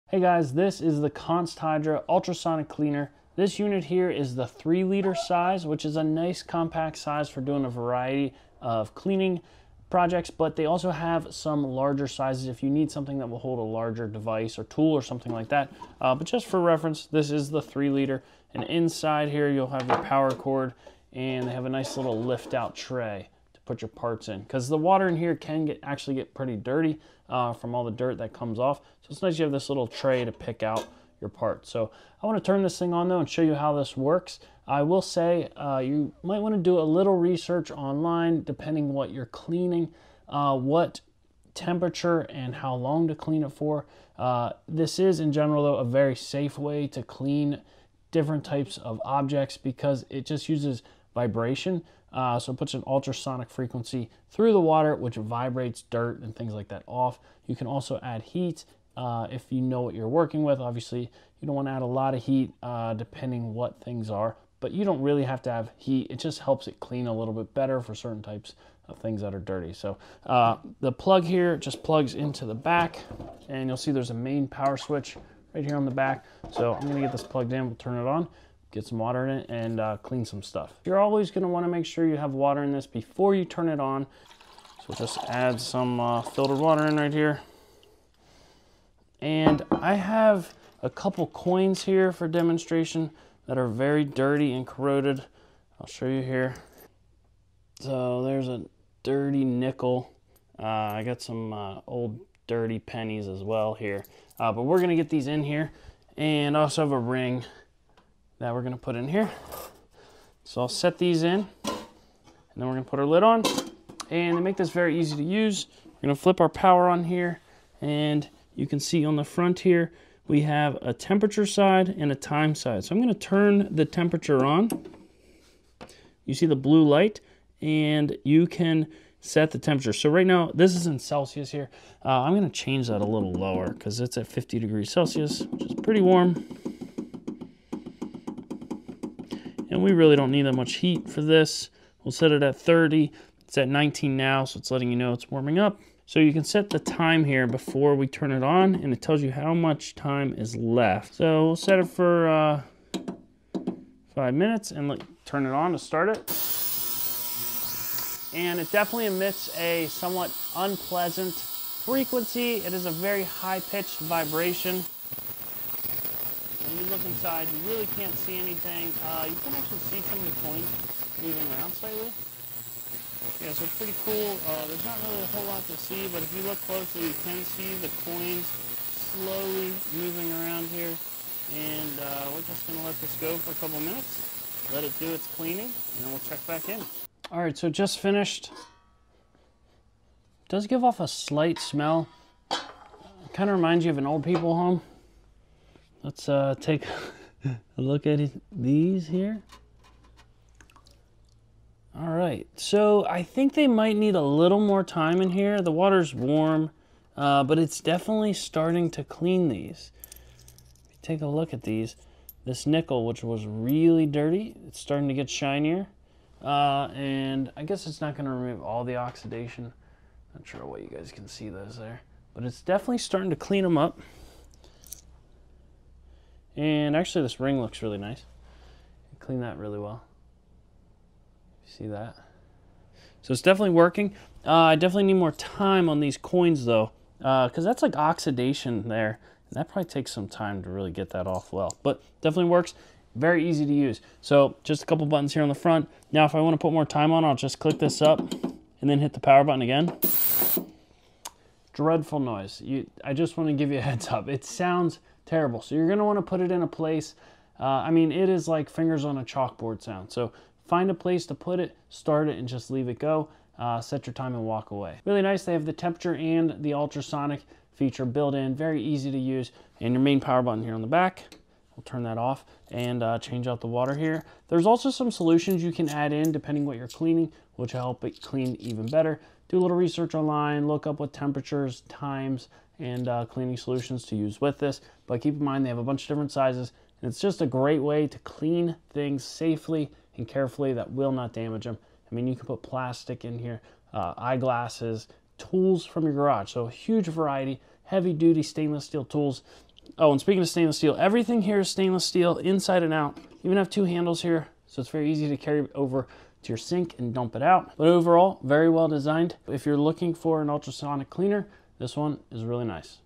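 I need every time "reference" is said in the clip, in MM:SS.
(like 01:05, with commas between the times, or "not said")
00:16.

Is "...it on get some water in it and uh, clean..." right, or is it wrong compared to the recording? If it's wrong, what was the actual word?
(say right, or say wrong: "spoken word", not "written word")
right.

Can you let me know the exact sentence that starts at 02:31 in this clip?
So we'll set it for uh, five minutes and let, turn it on to start it.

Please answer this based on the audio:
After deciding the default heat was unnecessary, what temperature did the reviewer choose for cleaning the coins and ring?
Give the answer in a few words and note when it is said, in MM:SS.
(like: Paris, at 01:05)
30, at 02:22.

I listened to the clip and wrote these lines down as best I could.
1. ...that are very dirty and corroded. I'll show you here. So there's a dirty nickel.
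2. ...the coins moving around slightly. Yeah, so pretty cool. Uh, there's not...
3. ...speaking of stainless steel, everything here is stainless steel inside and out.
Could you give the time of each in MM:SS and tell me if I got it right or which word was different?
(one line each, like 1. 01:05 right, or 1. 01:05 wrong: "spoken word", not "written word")
1. 01:33 right
2. 02:50 right
3. 05:00 right.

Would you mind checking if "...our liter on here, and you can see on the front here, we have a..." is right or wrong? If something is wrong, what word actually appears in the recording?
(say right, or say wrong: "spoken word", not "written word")
wrong: "power", not "liter".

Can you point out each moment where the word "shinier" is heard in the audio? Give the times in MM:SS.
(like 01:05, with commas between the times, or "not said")
03:35.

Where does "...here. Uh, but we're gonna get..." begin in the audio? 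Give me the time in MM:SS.
01:43.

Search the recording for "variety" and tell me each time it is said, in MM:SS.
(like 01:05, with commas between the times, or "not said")
00:07, 04:57.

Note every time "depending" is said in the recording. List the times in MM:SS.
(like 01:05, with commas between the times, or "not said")
00:38, 01:02, 04:36.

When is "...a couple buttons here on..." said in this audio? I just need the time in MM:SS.
04:04.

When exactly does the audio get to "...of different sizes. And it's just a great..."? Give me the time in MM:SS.
04:46.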